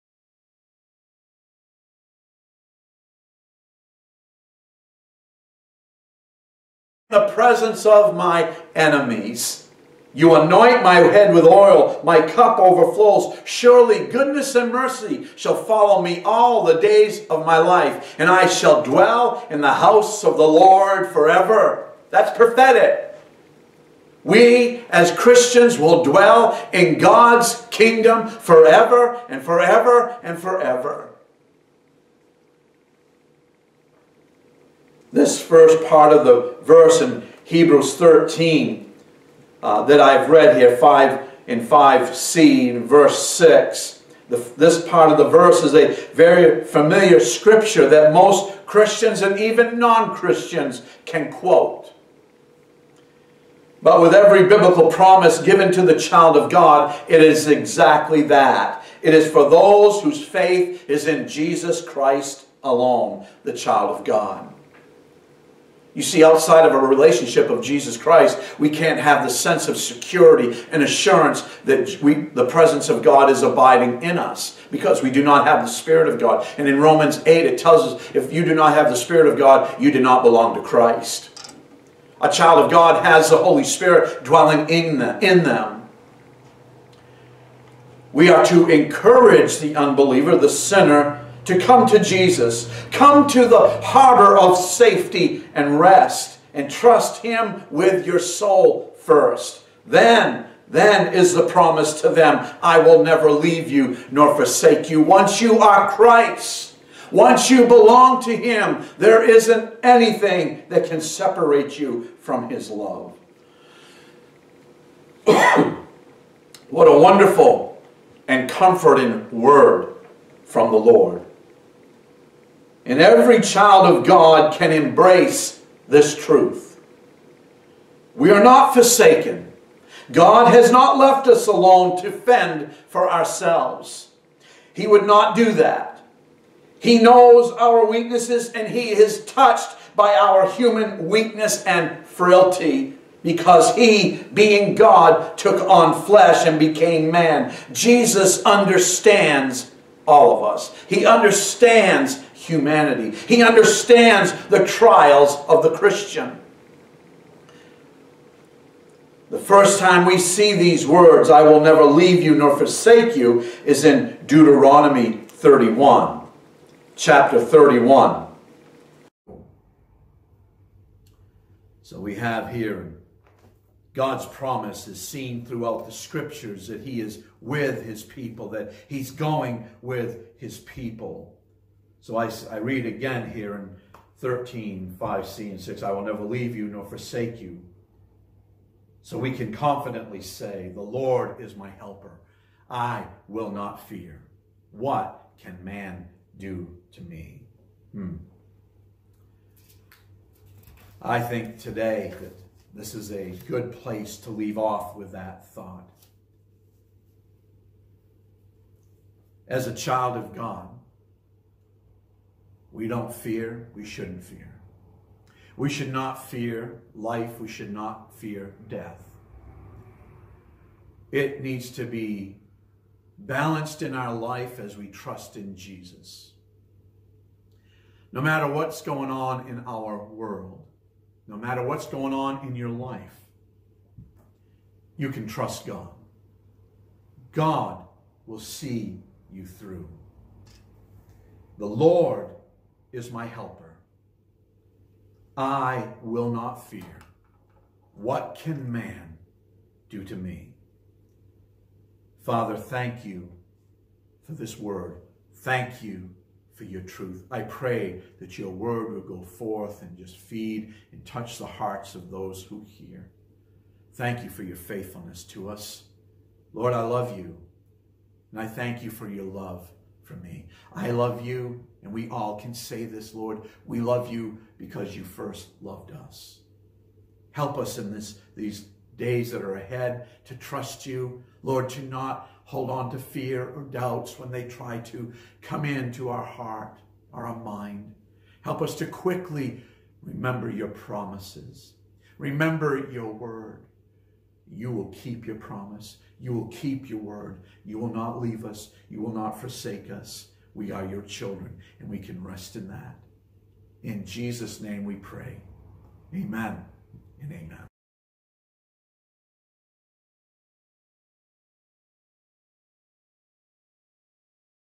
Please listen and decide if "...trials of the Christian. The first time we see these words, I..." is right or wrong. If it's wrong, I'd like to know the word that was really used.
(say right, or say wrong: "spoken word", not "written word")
right.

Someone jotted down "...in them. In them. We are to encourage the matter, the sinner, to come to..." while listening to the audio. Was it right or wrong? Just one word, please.
wrong.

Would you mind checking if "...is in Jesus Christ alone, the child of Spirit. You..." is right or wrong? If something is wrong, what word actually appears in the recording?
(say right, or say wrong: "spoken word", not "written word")
wrong: "God", not "Spirit".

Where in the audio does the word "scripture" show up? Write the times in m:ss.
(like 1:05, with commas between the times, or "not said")
0:47, 2:55.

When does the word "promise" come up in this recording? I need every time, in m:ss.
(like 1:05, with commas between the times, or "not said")
0:54, 1:41, 2:54, 4:50, 4:55.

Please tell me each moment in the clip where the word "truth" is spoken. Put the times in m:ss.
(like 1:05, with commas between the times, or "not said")
2:06, 4:16.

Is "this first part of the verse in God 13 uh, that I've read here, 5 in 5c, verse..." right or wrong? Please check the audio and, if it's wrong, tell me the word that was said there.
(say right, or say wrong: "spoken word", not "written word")
wrong: "Hebrews", not "God".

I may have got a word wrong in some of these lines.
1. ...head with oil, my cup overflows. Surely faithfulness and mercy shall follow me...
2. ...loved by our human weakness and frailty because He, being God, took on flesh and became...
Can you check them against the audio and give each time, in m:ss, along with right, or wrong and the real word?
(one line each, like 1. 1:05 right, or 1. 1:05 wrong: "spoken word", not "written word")
1. 0:10 wrong: "goodness", not "faithfulness"
2. 2:19 wrong: "touched", not "loved".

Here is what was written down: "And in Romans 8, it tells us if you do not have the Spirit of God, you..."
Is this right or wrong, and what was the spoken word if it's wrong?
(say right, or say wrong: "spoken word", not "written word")
right.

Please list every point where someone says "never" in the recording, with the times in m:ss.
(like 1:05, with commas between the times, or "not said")
1:43, 2:41, 3:06.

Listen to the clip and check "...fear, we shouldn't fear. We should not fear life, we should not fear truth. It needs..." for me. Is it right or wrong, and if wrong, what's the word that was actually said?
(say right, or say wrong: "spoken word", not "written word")
wrong: "death", not "truth".